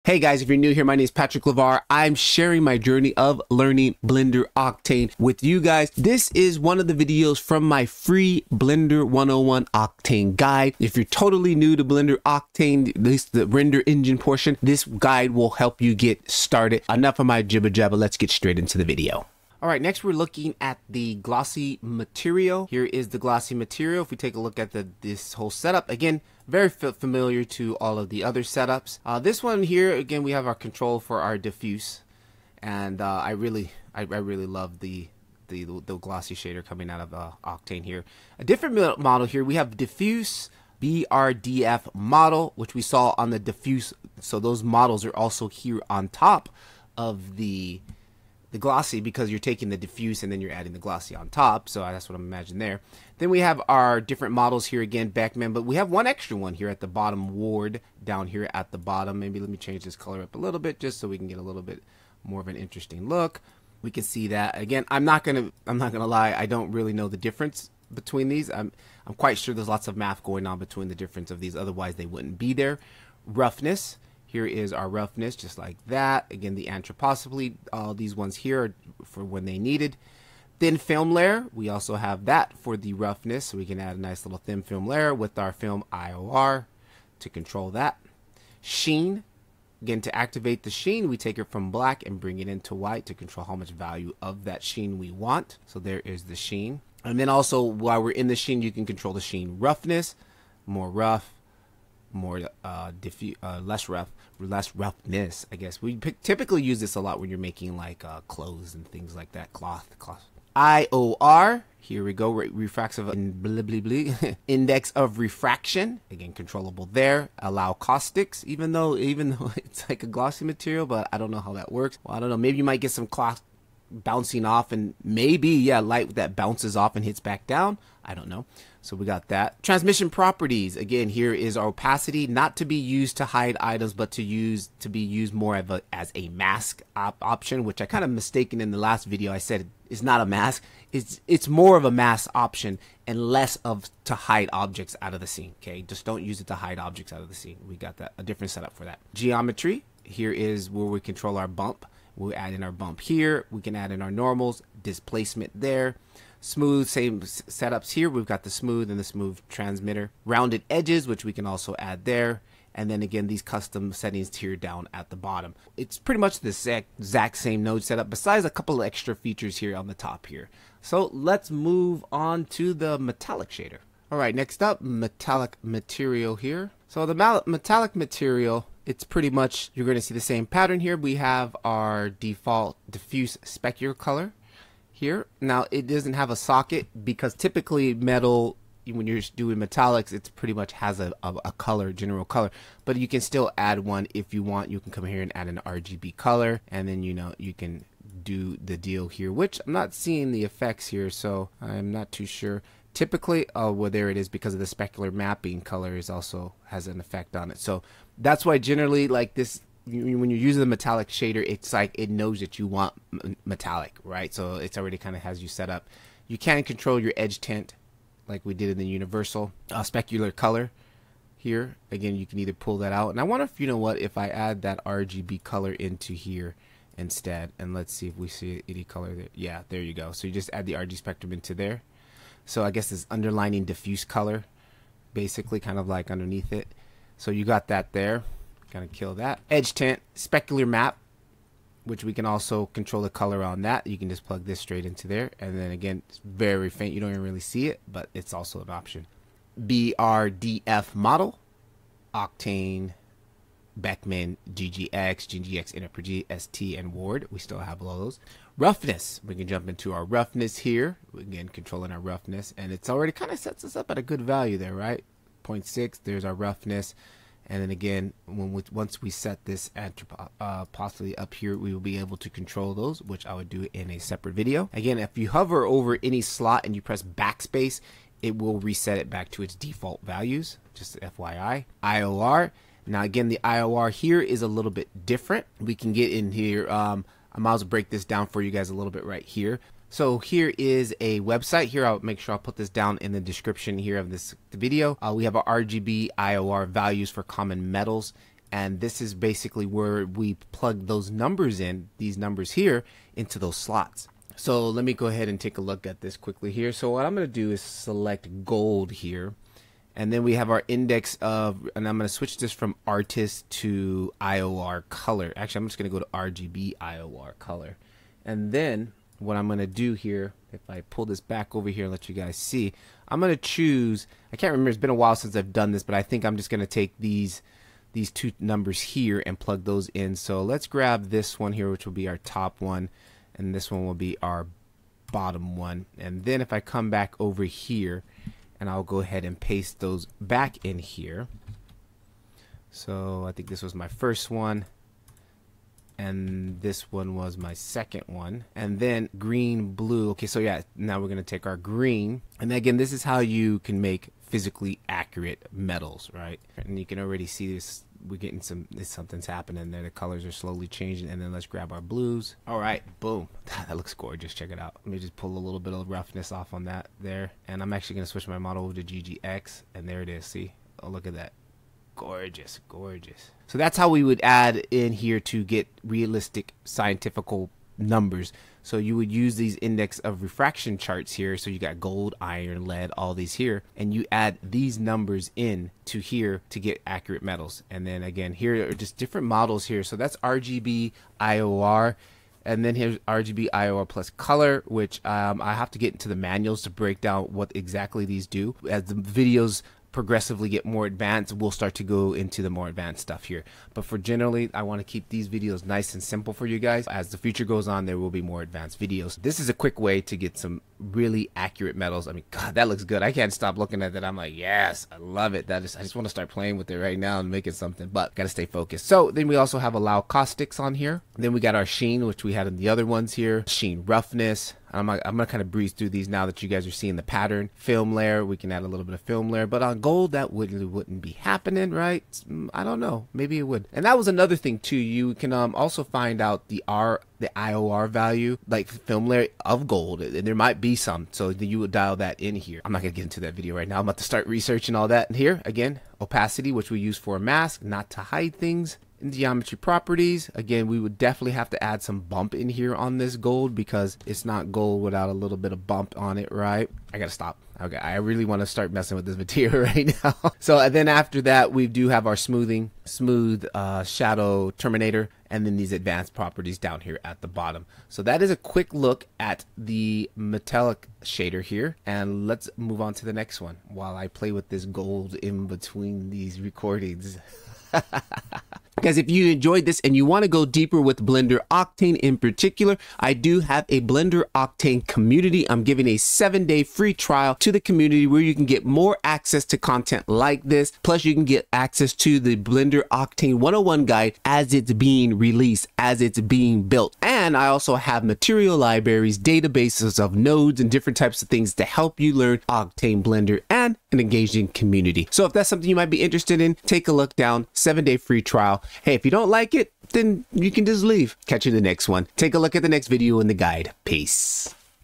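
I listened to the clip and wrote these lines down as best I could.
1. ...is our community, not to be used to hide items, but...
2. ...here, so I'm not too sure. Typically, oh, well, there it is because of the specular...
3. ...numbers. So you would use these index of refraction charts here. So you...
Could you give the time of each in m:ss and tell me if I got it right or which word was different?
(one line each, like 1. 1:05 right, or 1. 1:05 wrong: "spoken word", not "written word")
1. 2:11 wrong: "opacity", not "community"
2. 3:20 right
3. 6:17 right.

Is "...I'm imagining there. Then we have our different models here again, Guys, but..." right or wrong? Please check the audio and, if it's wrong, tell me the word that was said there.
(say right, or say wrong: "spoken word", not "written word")
wrong: "Beckmann", not "Guys".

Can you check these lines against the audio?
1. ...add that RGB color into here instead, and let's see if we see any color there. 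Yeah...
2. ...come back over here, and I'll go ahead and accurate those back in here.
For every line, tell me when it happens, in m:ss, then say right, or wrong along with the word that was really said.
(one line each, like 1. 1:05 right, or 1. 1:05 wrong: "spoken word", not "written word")
1. 3:44 right
2. 5:36 wrong: "paste", not "accurate".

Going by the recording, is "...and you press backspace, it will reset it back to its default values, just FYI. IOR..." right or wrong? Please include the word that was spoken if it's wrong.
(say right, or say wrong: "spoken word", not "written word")
right.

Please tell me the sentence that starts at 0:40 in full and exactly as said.
BRDF model, which we saw on the diffuse.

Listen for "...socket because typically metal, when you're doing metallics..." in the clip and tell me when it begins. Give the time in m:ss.
3:06.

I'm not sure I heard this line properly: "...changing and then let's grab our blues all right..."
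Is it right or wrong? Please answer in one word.
right.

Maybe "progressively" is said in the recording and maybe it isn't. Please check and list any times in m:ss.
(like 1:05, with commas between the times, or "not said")
6:39.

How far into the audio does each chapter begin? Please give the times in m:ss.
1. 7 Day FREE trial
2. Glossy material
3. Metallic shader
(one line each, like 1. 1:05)
1. 7:58
2. 0:19
3. 2:53.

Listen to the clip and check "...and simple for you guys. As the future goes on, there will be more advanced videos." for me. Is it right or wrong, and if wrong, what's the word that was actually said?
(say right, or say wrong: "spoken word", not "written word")
right.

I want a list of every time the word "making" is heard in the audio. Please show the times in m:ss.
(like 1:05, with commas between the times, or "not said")
1:47, 6:57.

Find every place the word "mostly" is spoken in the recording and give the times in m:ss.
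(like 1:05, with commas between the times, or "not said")
not said.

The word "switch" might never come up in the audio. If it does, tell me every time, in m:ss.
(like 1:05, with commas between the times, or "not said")
5:12, 6:08.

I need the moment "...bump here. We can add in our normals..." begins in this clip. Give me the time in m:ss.
2:32.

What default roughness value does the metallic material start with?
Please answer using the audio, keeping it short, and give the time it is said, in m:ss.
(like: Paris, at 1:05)
0.6, at 4:25.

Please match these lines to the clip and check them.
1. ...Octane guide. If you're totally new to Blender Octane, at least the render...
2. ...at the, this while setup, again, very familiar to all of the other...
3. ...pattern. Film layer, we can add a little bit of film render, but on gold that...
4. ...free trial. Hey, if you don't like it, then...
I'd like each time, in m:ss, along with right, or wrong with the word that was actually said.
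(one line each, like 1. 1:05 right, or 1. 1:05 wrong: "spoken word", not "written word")
1. 0:09 right
2. 0:24 wrong: "whole", not "while"
3. 7:07 wrong: "layer", not "render"
4. 8:27 right.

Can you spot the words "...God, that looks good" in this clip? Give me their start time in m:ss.
6:52.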